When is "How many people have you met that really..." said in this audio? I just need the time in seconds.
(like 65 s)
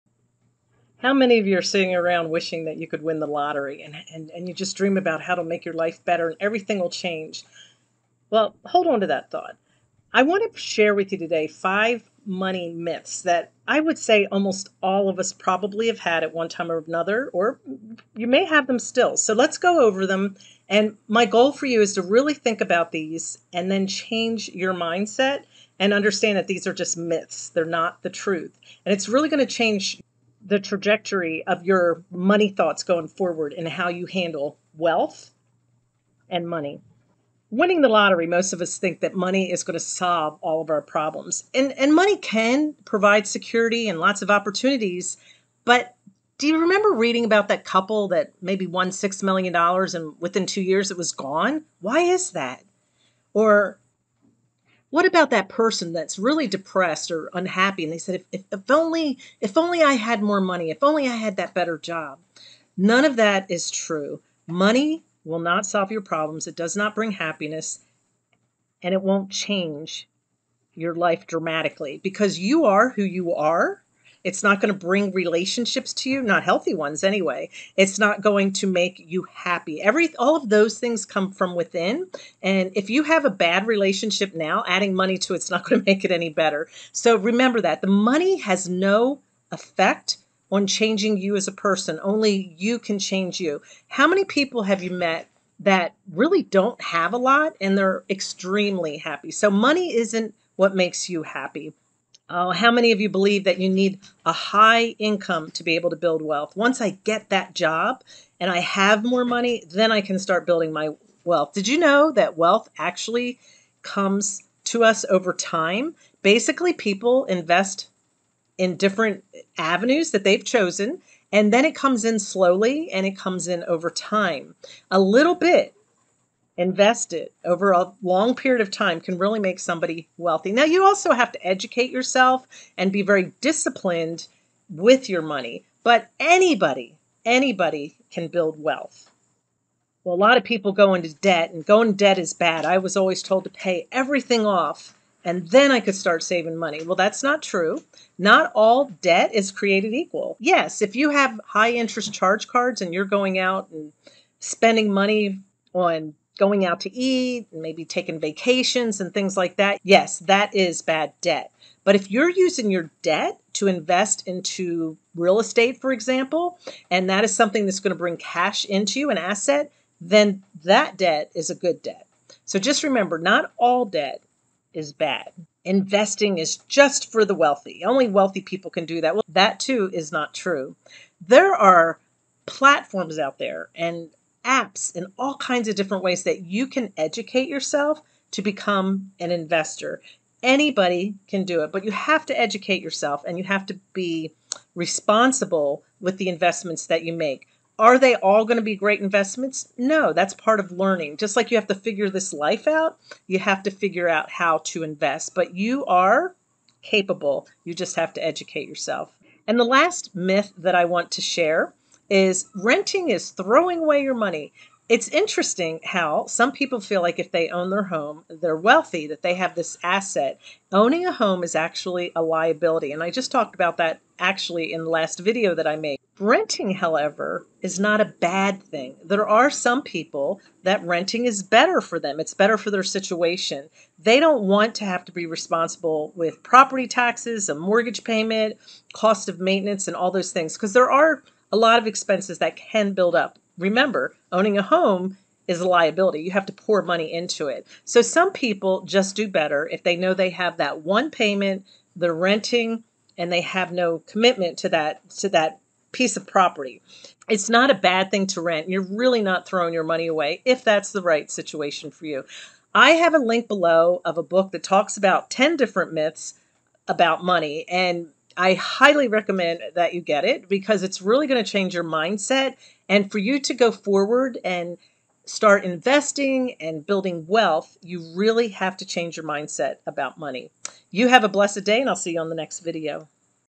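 93 s.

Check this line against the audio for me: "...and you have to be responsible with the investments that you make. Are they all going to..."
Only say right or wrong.
right.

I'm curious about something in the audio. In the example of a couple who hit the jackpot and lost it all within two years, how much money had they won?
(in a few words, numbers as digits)
$6 million.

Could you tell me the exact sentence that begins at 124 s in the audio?
A little bit invested over a long period of time can really make somebody wealthy.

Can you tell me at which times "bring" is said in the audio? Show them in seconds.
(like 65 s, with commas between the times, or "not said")
66 s, 74 s, 167 s.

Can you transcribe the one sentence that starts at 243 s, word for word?
Remember, owning a home is a liability.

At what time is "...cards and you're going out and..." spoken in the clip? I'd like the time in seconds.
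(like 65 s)
152 s.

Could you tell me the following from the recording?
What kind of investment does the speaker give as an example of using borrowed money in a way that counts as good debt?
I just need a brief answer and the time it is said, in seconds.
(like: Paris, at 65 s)
real estate, at 165 s.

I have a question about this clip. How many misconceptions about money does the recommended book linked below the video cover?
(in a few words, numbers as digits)
10.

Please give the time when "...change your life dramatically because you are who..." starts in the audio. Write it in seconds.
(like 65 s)
69 s.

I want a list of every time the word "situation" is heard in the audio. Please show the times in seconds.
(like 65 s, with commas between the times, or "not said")
232 s, 261 s.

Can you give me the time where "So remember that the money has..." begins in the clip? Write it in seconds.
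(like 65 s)
86 s.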